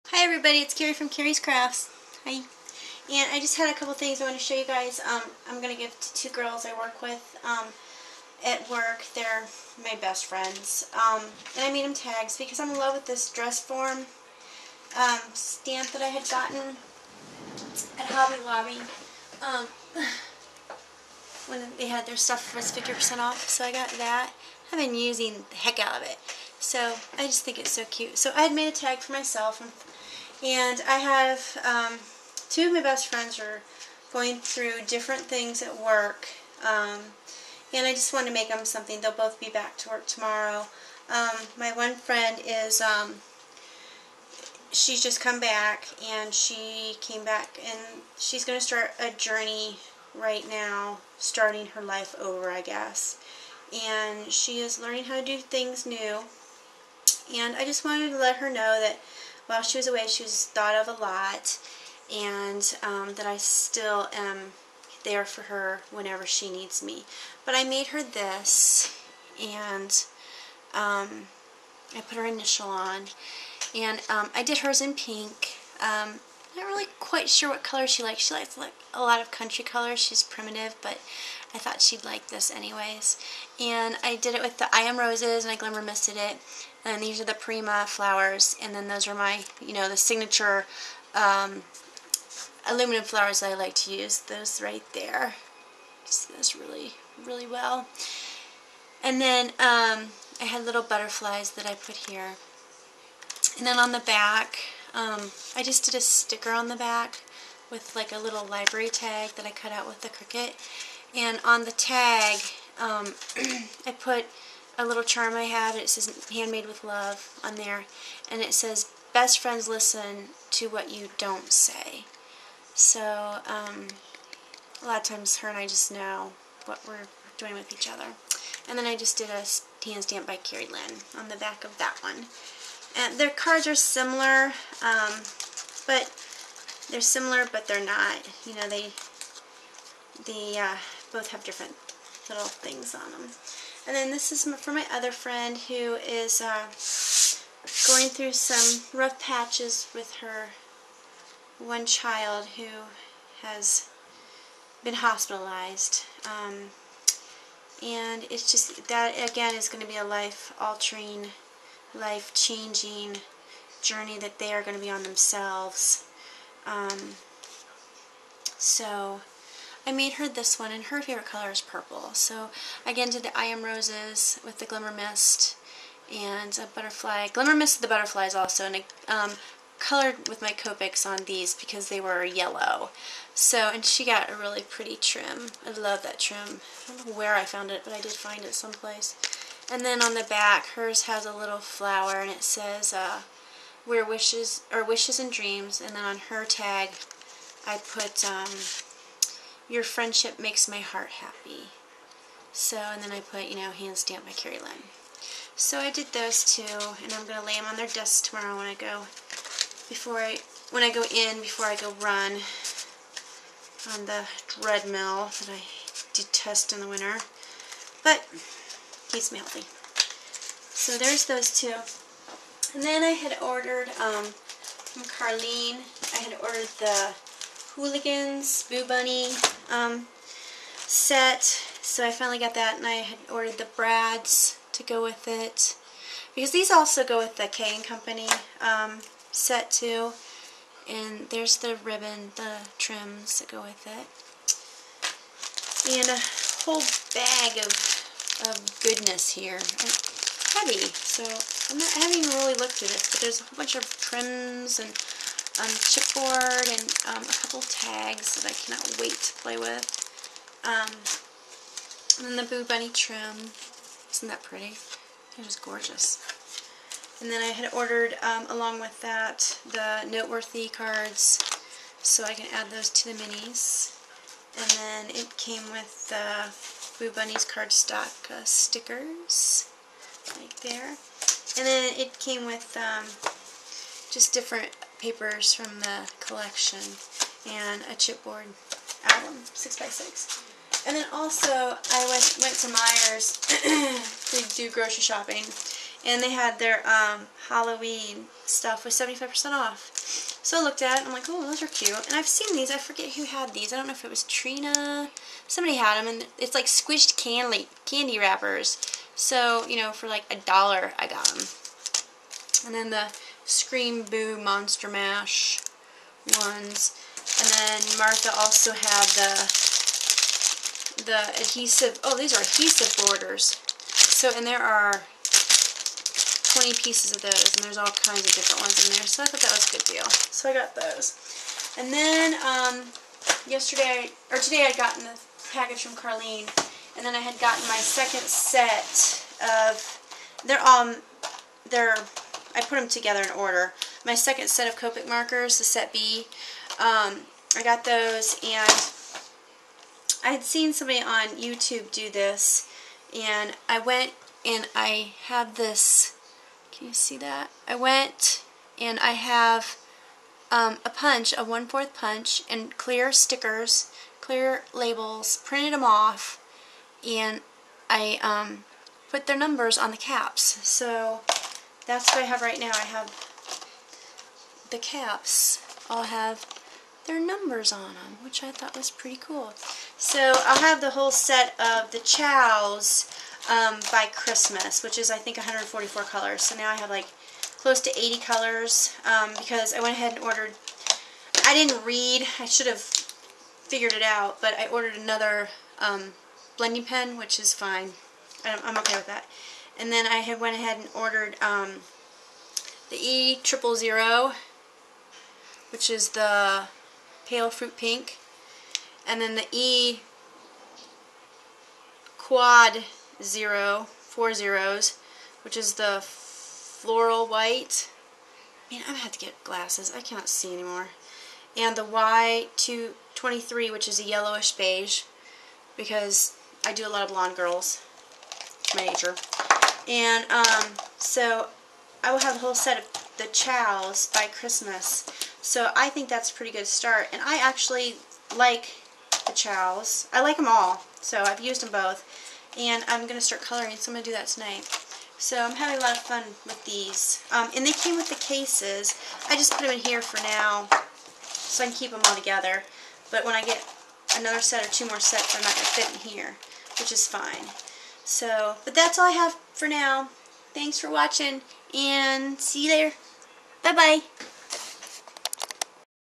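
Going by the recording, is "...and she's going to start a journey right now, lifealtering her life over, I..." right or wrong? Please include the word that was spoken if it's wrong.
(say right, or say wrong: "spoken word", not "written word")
wrong: "starting", not "lifealtering".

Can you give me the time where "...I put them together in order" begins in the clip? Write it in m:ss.
5:42.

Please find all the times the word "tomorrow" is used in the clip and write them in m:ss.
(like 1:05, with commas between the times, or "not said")
0:40, 3:28.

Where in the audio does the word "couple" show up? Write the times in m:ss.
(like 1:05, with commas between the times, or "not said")
0:03, 4:17.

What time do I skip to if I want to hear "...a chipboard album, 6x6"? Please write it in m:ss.
4:47.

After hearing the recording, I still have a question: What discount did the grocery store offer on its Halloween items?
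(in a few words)
75%.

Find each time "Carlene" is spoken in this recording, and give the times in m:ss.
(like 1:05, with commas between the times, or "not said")
3:45, 5:35.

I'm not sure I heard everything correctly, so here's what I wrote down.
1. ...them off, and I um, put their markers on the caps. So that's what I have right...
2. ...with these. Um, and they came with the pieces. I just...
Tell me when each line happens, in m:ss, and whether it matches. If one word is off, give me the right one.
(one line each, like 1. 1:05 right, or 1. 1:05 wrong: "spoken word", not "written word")
1. 6:05 wrong: "numbers", not "markers"
2. 7:26 wrong: "cases", not "pieces".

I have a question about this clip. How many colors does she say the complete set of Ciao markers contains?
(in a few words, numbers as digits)
144.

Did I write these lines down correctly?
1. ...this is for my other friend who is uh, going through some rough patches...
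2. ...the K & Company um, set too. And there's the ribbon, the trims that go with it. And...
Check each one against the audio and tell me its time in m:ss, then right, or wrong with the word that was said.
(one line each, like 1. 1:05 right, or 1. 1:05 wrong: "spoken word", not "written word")
1. 2:24 right
2. 3:57 right.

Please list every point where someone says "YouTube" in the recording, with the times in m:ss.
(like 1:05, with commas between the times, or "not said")
5:51.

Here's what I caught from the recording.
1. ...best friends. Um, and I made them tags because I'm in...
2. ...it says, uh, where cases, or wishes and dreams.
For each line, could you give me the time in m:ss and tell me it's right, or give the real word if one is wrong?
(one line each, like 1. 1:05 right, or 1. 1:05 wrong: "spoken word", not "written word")
1. 0:10 right
2. 3:12 wrong: "wishes", not "cases".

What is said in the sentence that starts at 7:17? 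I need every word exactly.
And I actually like the Ciaos.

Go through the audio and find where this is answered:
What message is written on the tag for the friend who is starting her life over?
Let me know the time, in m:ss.
1:59.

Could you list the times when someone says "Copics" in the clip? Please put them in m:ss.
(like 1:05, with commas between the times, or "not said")
3:00, 5:44.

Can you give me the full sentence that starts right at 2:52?
So again did the I Am Roses with the Glimmer Mist and a butterfly.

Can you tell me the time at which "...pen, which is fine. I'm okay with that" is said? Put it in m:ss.
6:36.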